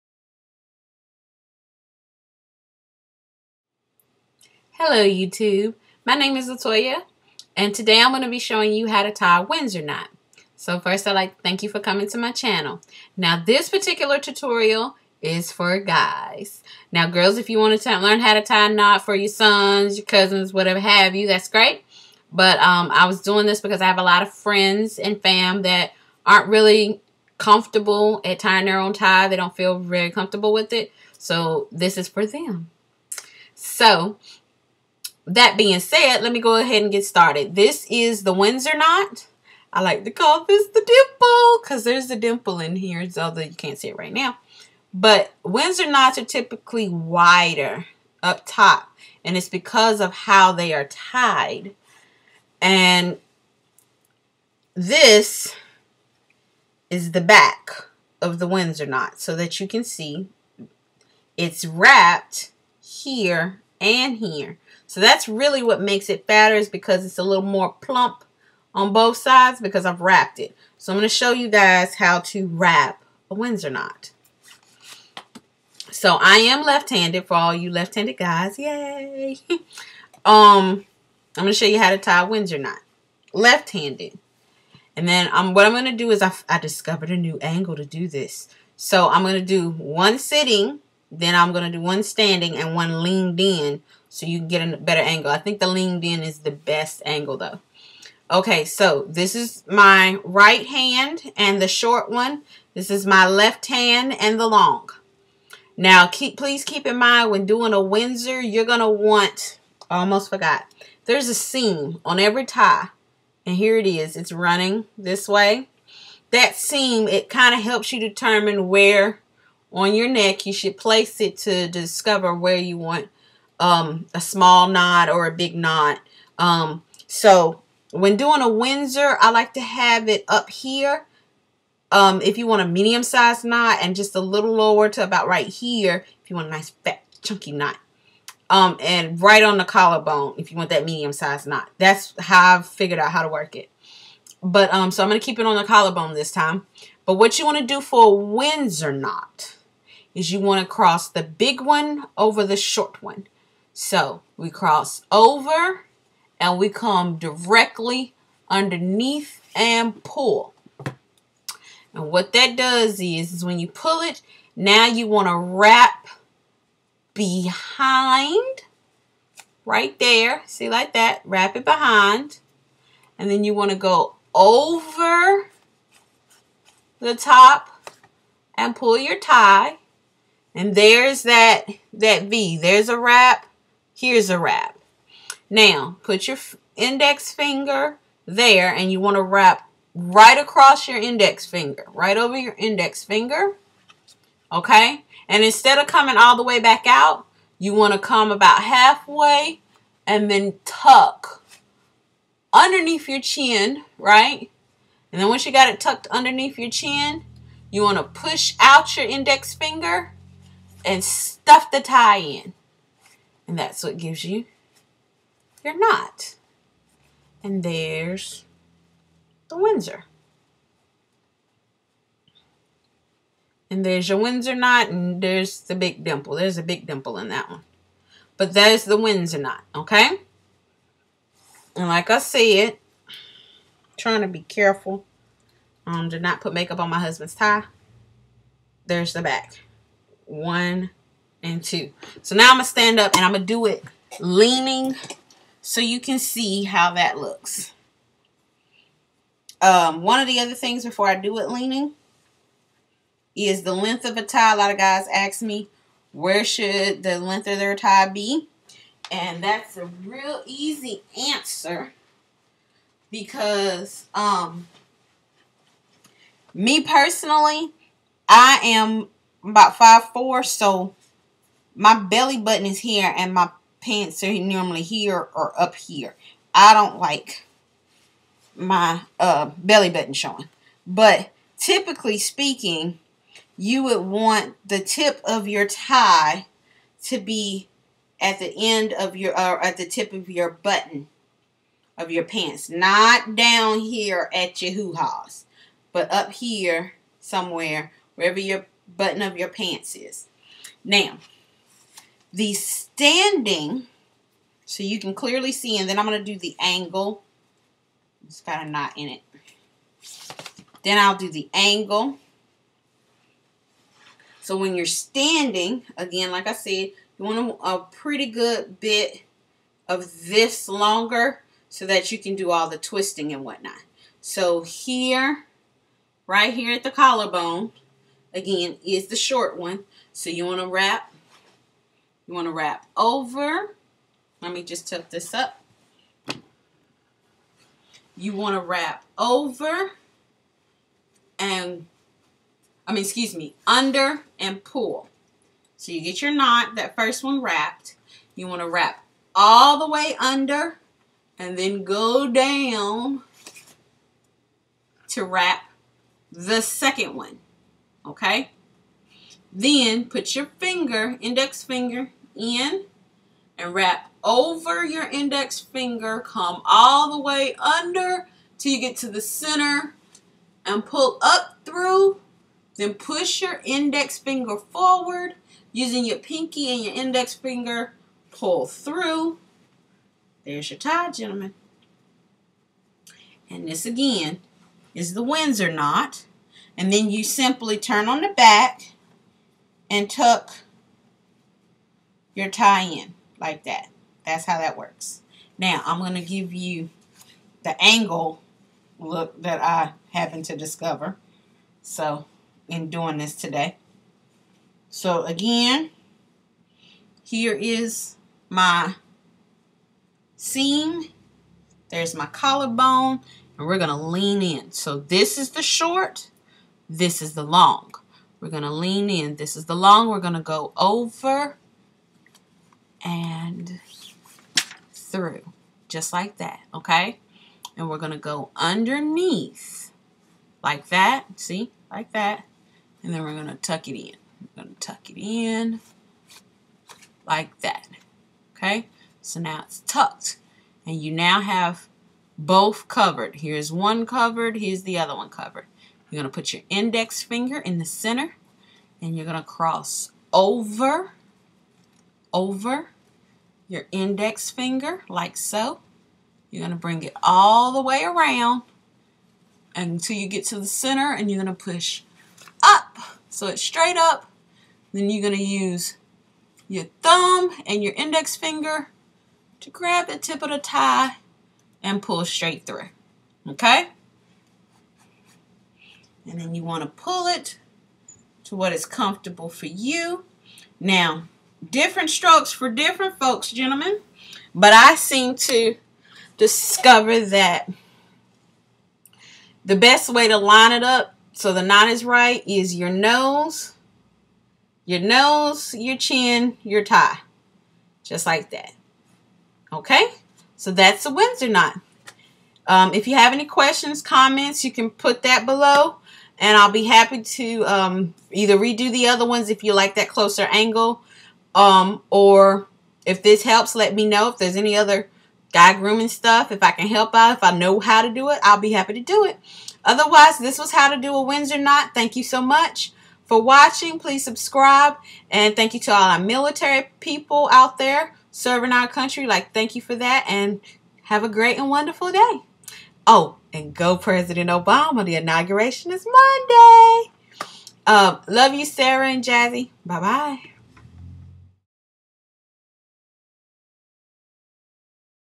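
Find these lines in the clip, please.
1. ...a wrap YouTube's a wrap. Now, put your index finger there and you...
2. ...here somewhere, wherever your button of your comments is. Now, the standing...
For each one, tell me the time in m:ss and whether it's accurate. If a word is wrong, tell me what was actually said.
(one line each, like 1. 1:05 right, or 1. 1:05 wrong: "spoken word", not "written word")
1. 3:02 wrong: "Here", not "YouTube"
2. 4:56 wrong: "pants", not "comments".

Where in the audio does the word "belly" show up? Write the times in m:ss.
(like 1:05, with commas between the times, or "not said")
4:31, 4:39.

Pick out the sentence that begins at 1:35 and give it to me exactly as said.
I think the leaned in is the best angle though.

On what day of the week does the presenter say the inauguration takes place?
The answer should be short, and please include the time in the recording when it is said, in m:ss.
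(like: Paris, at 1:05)
Monday, at 8:56.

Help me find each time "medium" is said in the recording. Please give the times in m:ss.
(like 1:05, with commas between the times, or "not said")
2:12, 2:20.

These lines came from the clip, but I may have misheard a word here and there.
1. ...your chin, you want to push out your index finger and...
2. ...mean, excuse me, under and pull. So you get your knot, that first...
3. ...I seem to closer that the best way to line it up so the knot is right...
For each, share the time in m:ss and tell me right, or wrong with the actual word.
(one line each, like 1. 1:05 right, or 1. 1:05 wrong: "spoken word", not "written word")
1. 3:26 right
2. 5:42 right
3. 8:04 wrong: "discover", not "closer".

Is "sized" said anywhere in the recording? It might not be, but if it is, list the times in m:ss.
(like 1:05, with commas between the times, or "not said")
2:13, 2:21.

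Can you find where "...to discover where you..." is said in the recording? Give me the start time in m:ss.
2:01.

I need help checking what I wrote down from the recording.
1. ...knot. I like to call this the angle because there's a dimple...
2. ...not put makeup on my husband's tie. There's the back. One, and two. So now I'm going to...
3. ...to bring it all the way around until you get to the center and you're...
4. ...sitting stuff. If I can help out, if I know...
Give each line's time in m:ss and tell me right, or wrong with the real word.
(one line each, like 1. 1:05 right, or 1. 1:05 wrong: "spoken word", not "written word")
1. 0:38 wrong: "dimple", not "angle"
2. 3:56 right
3. 7:36 right
4. 8:35 wrong: "grooming", not "sitting".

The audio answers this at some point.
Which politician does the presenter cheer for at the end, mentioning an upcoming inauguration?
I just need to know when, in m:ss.
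8:53.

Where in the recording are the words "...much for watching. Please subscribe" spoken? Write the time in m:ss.
8:42.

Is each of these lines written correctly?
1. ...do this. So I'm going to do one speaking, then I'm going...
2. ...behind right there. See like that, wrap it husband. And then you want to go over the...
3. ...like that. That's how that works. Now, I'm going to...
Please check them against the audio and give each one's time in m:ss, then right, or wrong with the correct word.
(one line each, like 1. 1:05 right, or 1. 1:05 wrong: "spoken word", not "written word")
1. 1:27 wrong: "sitting", not "speaking"
2. 2:47 wrong: "behind", not "husband"
3. 6:33 right.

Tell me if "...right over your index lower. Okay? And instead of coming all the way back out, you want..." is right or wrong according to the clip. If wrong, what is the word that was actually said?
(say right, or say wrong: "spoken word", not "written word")
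wrong: "finger", not "lower".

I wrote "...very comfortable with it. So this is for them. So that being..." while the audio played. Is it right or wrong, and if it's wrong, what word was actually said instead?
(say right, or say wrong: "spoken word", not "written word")
right.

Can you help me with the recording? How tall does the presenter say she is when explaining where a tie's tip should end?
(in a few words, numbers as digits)
5'4".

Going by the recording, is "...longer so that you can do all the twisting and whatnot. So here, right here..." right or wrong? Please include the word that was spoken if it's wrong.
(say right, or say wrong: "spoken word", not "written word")
right.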